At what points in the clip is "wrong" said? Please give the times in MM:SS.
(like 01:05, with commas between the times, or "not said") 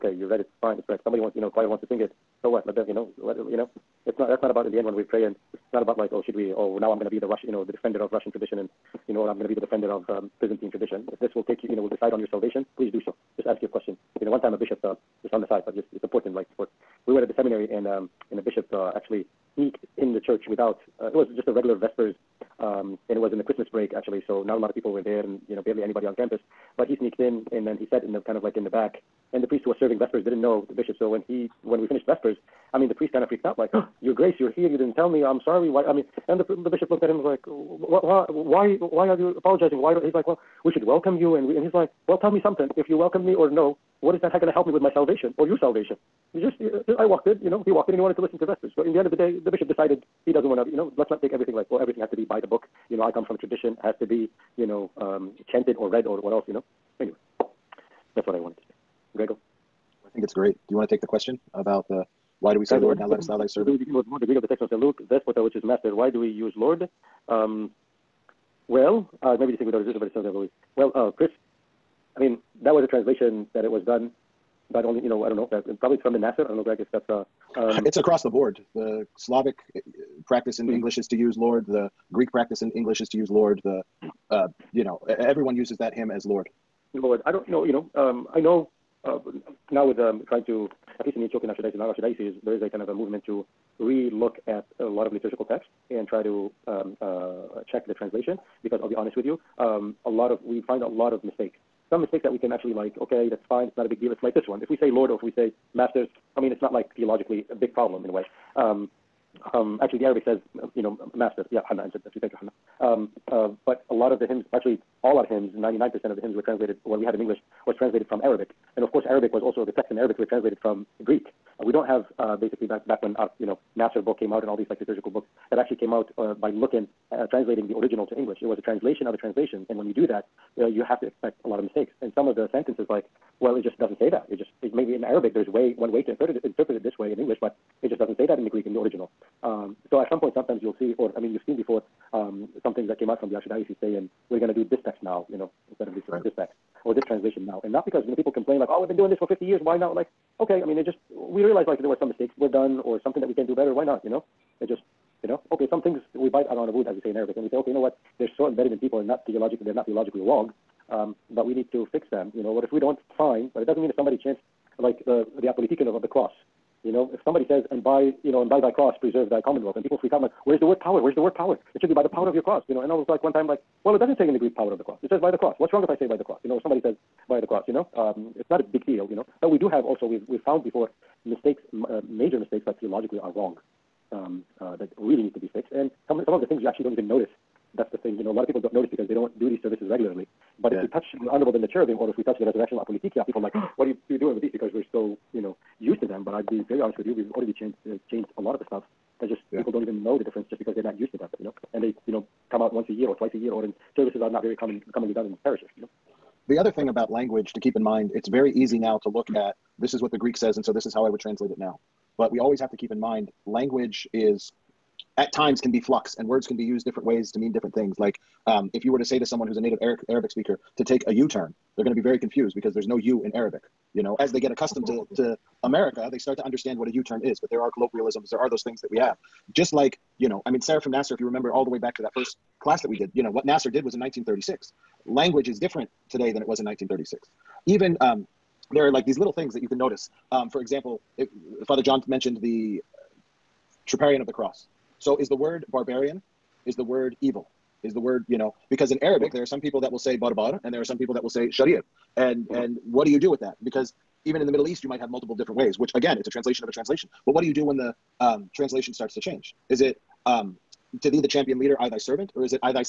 02:40, 02:55, 03:03.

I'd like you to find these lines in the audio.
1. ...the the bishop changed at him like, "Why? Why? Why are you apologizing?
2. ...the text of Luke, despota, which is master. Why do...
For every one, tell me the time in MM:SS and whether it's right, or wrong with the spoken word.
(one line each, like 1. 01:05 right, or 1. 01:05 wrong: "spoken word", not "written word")
1. 00:36 wrong: "looked", not "changed"
2. 01:04 right.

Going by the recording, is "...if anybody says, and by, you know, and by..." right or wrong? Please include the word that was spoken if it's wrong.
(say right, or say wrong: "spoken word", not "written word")
wrong: "somebody", not "anybody".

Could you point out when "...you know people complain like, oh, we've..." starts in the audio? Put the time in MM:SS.
02:28.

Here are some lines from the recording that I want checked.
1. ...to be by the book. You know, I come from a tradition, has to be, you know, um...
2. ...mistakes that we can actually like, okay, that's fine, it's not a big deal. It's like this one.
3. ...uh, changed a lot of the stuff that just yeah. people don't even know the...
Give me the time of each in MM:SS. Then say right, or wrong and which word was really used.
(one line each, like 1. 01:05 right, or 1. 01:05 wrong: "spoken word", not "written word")
1. 00:52 right
2. 01:42 right
3. 03:17 right.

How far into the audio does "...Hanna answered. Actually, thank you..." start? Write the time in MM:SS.
01:51.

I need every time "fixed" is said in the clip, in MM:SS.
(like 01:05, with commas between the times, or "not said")
03:05.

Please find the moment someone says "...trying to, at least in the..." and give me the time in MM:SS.
01:30.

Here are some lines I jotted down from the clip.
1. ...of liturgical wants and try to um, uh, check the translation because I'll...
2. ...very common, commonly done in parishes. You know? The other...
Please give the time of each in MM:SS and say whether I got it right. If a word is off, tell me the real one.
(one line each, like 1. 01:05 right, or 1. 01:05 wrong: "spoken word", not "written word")
1. 01:35 wrong: "texts", not "wants"
2. 03:24 right.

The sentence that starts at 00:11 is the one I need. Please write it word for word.
If this will take you, you know, will decide on your salvation, please do so.